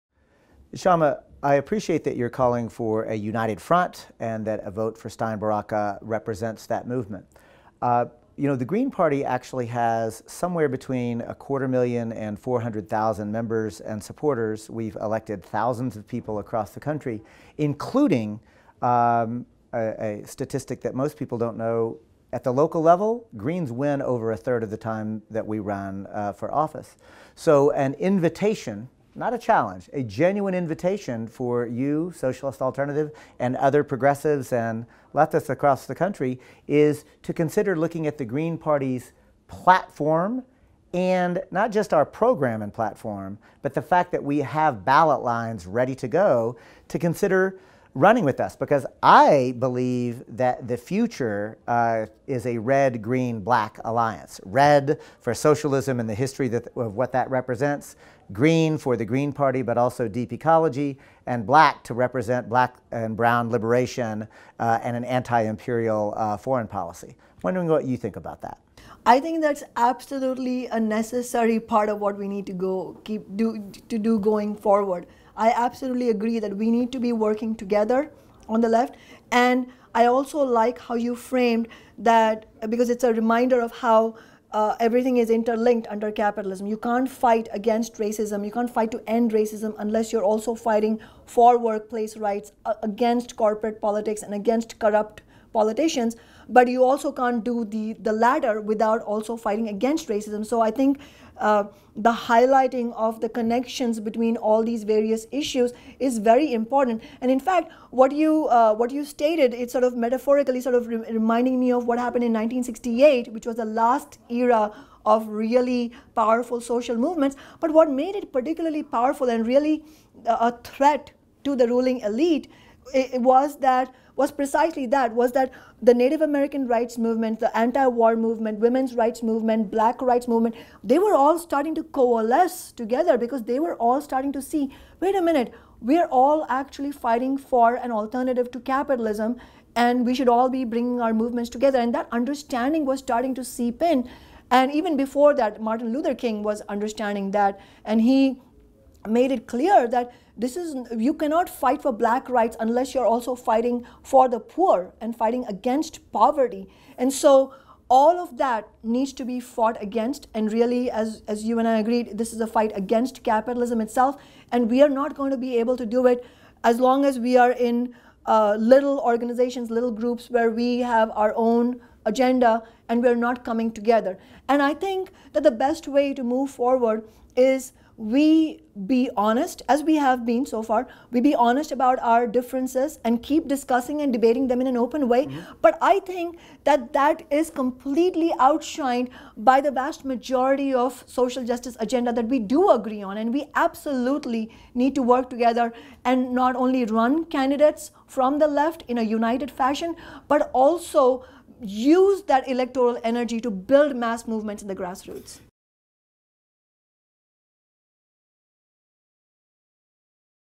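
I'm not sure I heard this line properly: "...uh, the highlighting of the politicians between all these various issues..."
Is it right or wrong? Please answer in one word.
wrong.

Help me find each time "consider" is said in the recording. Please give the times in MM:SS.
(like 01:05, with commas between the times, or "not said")
00:37, 00:46.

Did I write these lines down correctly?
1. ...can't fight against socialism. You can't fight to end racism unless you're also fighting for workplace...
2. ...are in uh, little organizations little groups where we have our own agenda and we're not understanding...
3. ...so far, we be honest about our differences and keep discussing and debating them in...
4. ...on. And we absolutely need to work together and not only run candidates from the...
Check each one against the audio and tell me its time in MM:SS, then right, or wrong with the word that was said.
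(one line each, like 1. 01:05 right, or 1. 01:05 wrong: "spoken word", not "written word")
1. 01:26 wrong: "racism", not "socialism"
2. 02:47 wrong: "coming", not "understanding"
3. 03:00 right
4. 03:13 right.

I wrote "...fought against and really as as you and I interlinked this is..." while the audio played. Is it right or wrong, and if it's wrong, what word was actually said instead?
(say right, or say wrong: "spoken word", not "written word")
wrong: "agreed", not "interlinked".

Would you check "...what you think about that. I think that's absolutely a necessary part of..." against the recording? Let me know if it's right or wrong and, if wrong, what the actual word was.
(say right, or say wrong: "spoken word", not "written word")
right.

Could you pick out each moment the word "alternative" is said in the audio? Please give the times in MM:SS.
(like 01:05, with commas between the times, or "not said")
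00:32, 02:17.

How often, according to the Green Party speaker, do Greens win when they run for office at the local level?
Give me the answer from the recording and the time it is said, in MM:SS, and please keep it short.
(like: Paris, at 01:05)
over a third of the time, at 00:24.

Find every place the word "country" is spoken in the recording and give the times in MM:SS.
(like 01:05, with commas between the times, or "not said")
00:16, 00:35.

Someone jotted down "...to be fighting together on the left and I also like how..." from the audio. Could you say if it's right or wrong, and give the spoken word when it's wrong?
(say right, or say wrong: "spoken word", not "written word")
wrong: "working", not "fighting".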